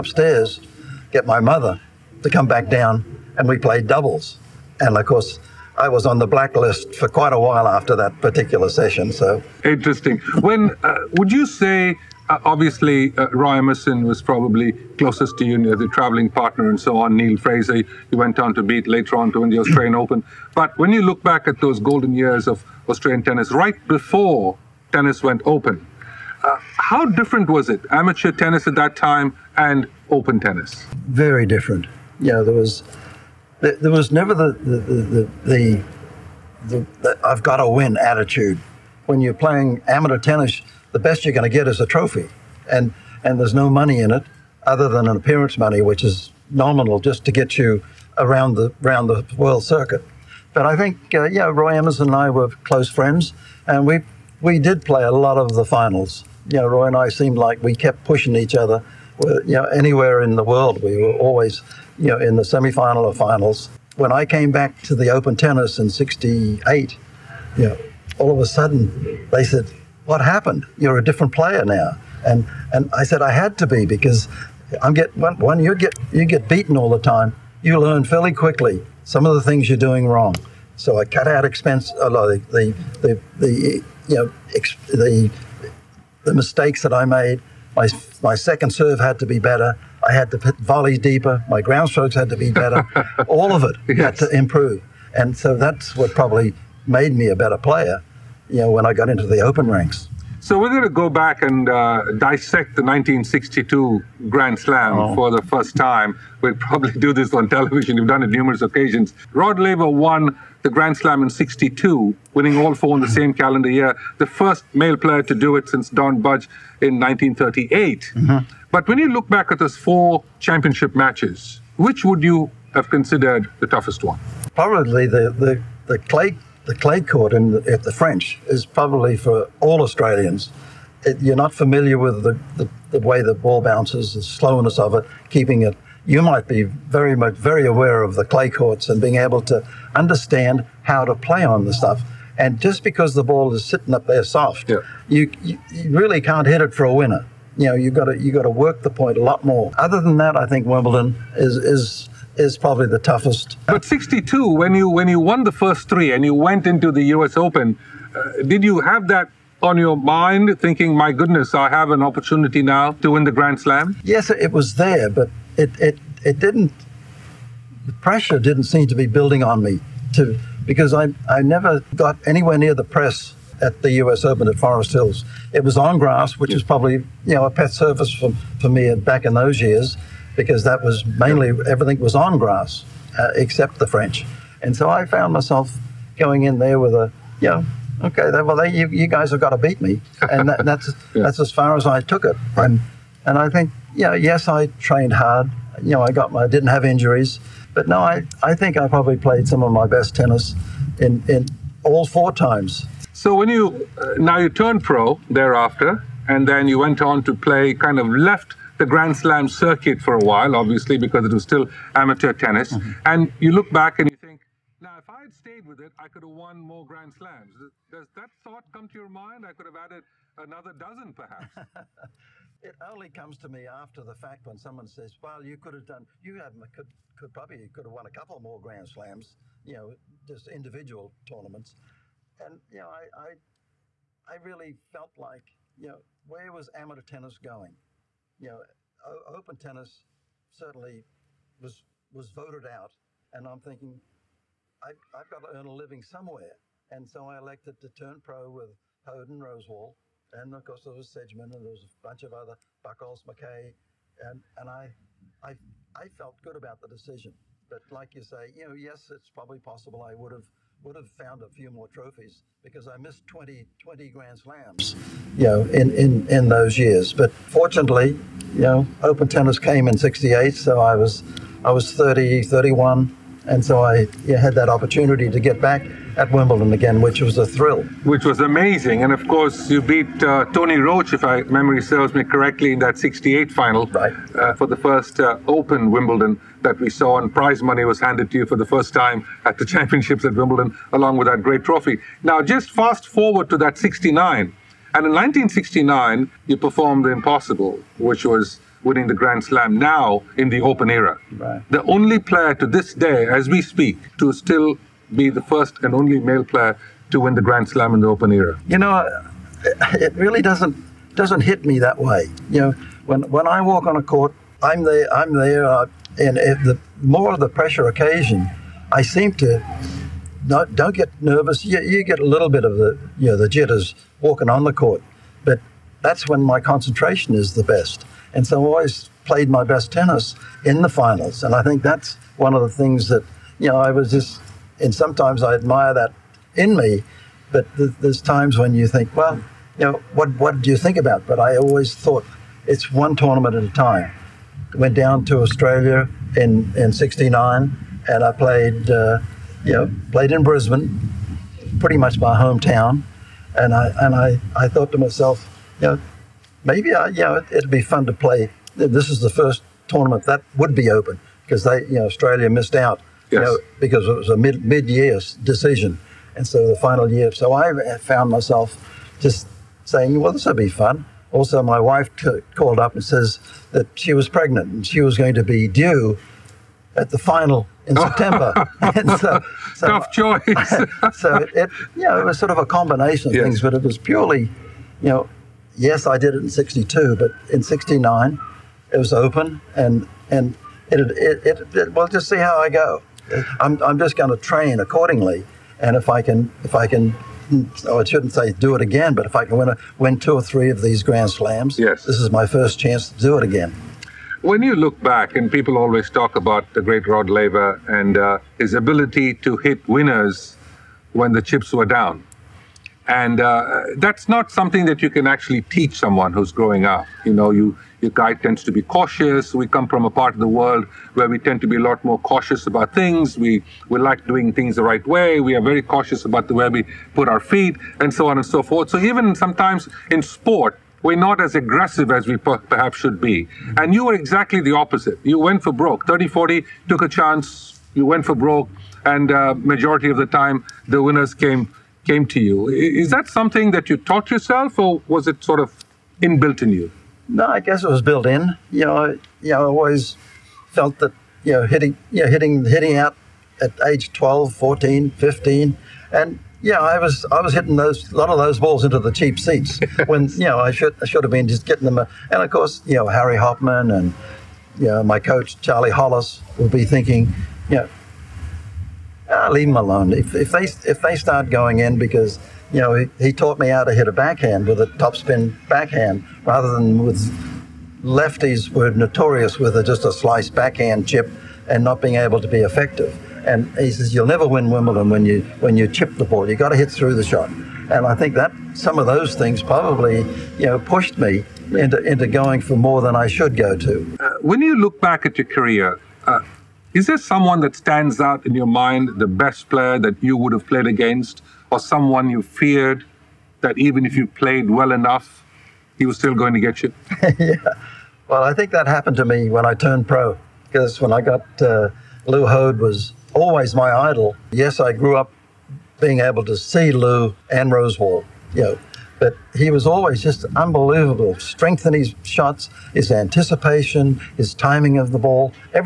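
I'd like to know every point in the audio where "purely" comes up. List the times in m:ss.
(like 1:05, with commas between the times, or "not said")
6:23.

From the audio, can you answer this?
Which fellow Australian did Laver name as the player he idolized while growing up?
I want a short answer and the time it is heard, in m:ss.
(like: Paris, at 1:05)
Lew Hoad, at 8:32.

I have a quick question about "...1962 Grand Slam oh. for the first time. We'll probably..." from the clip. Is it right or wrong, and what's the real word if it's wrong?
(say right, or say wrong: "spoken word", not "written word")
right.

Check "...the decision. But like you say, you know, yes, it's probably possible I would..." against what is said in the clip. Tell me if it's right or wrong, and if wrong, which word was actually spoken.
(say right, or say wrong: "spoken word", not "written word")
right.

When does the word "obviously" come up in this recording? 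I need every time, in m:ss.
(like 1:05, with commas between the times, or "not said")
0:12, 3:30.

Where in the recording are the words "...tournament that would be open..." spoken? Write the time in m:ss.
5:59.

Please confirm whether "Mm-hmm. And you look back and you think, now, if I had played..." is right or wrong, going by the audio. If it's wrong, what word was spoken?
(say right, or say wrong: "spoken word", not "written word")
wrong: "stayed", not "played".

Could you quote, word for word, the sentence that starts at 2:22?
And just because the ball is sitting up there soft, yeah.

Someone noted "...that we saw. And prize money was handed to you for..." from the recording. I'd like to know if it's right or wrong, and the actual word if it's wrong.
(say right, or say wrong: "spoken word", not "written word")
right.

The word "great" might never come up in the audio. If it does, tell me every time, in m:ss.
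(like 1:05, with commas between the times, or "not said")
4:51, 6:46.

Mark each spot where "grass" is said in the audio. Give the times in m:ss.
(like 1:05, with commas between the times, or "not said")
2:55, 3:02.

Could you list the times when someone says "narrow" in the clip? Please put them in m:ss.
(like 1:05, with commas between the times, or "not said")
not said.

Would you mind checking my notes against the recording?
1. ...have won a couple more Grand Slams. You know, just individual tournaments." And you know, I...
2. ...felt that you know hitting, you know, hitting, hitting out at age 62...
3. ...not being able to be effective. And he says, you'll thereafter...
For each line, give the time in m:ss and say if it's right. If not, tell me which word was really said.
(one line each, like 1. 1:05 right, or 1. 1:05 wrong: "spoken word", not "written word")
1. 3:47 right
2. 7:30 wrong: "12", not "62"
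3. 8:01 wrong: "never", not "thereafter".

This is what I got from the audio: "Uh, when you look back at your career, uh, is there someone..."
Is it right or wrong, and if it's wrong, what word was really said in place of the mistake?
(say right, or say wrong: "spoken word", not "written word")
right.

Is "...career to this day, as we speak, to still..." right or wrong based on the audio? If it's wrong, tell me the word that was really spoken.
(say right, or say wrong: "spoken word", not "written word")
wrong: "player", not "career".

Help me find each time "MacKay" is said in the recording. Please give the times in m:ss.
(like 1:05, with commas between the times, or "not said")
4:13.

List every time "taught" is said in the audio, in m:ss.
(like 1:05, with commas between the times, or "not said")
7:23, 7:53.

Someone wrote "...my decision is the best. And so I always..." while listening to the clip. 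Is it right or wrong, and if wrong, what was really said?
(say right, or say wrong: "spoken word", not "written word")
wrong: "concentration", not "decision".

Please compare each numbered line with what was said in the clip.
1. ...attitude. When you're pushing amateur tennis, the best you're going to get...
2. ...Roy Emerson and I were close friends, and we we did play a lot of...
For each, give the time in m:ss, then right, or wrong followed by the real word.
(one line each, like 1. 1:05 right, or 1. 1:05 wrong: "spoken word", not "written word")
1. 0:37 wrong: "playing", not "pushing"
2. 0:51 right.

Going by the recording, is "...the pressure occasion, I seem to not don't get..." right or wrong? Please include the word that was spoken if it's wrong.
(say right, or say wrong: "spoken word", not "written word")
right.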